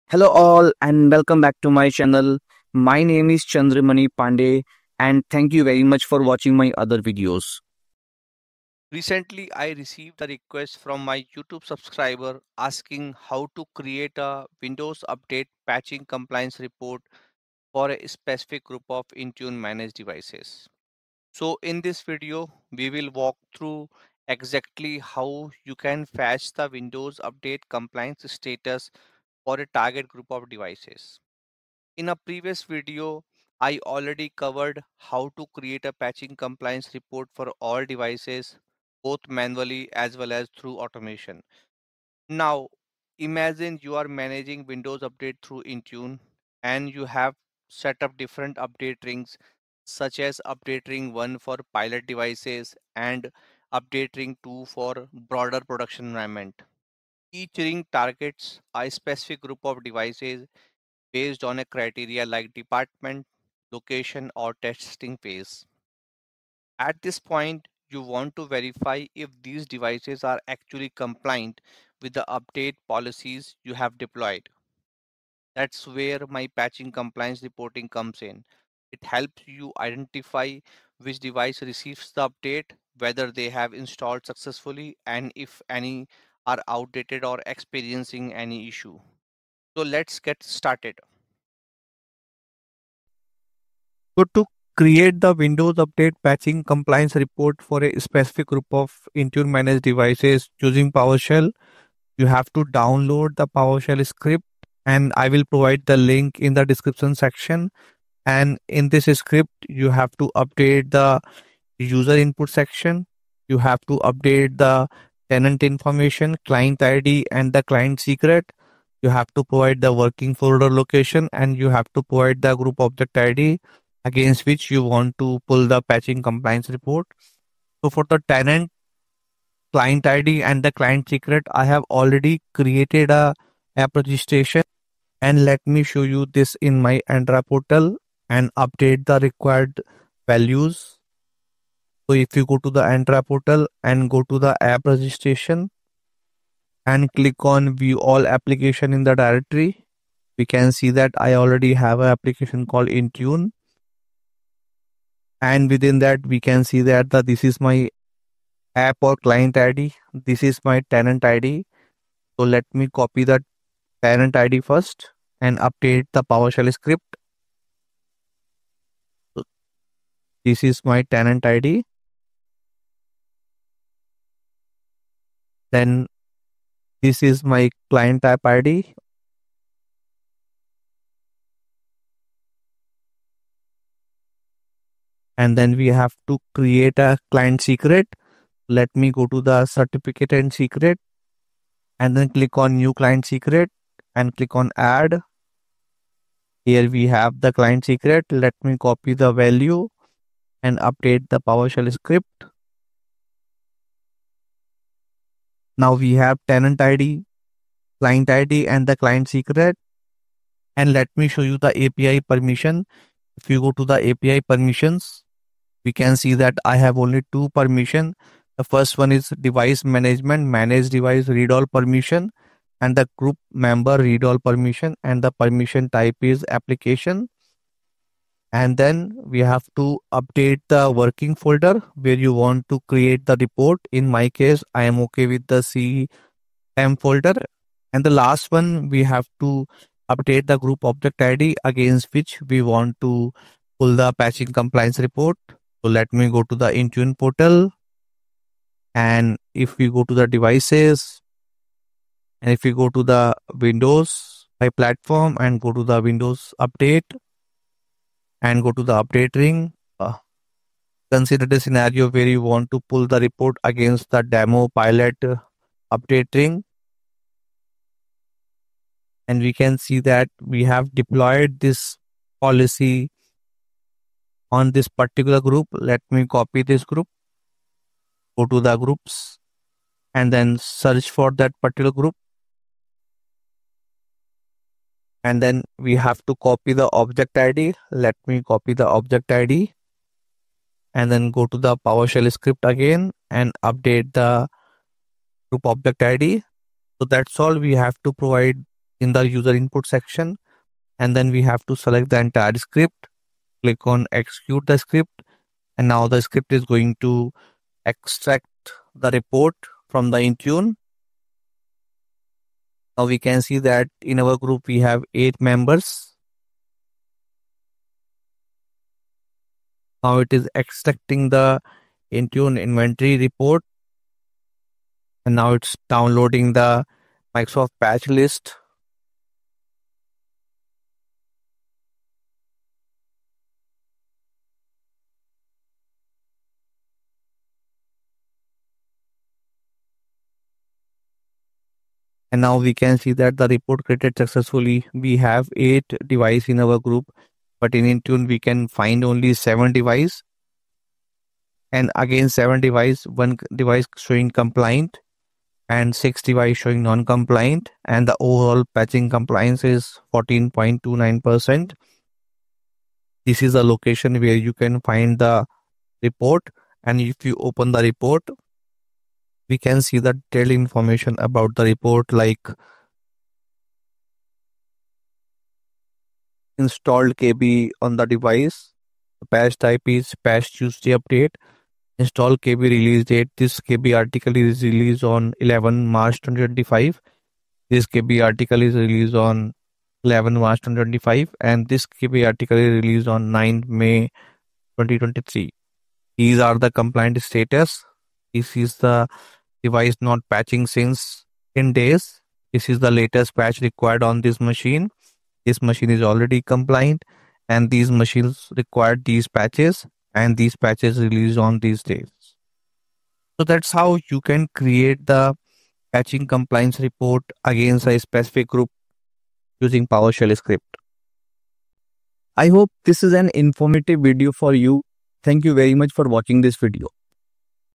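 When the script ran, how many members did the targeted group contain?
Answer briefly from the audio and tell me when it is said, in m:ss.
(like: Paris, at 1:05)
8, at 5:15.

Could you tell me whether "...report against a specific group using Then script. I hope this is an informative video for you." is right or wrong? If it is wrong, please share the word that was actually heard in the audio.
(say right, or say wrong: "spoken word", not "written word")
wrong: "PowerShell", not "Then".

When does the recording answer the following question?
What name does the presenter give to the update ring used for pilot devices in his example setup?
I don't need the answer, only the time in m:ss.
0:50.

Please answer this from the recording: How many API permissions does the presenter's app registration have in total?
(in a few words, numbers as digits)
2.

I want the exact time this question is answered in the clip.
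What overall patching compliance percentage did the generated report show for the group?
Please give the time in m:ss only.
6:00.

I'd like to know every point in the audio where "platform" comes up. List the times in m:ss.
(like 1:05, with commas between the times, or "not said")
4:14.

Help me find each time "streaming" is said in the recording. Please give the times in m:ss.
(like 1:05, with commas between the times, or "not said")
not said.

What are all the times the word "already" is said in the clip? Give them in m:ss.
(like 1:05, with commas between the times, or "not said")
0:33, 2:11, 2:31, 6:46.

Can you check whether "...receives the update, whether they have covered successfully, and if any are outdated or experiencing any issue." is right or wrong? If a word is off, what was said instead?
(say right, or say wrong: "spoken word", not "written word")
wrong: "installed", not "covered".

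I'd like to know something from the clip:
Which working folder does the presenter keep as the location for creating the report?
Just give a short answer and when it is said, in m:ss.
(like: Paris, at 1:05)
cm folder, at 3:55.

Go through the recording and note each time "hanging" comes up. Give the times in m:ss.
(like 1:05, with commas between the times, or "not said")
not said.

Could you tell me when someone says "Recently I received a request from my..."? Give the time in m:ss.
0:08.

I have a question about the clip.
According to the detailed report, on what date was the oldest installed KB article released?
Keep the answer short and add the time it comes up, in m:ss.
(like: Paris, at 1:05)
9 May 2023, at 6:33.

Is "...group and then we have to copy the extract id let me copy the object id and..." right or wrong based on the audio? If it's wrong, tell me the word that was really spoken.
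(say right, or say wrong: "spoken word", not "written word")
wrong: "object", not "extract".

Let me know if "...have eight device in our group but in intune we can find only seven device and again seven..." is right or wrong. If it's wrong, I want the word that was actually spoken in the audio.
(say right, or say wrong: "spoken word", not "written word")
right.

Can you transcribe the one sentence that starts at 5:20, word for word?
Now it is extracting the Intune inventory report.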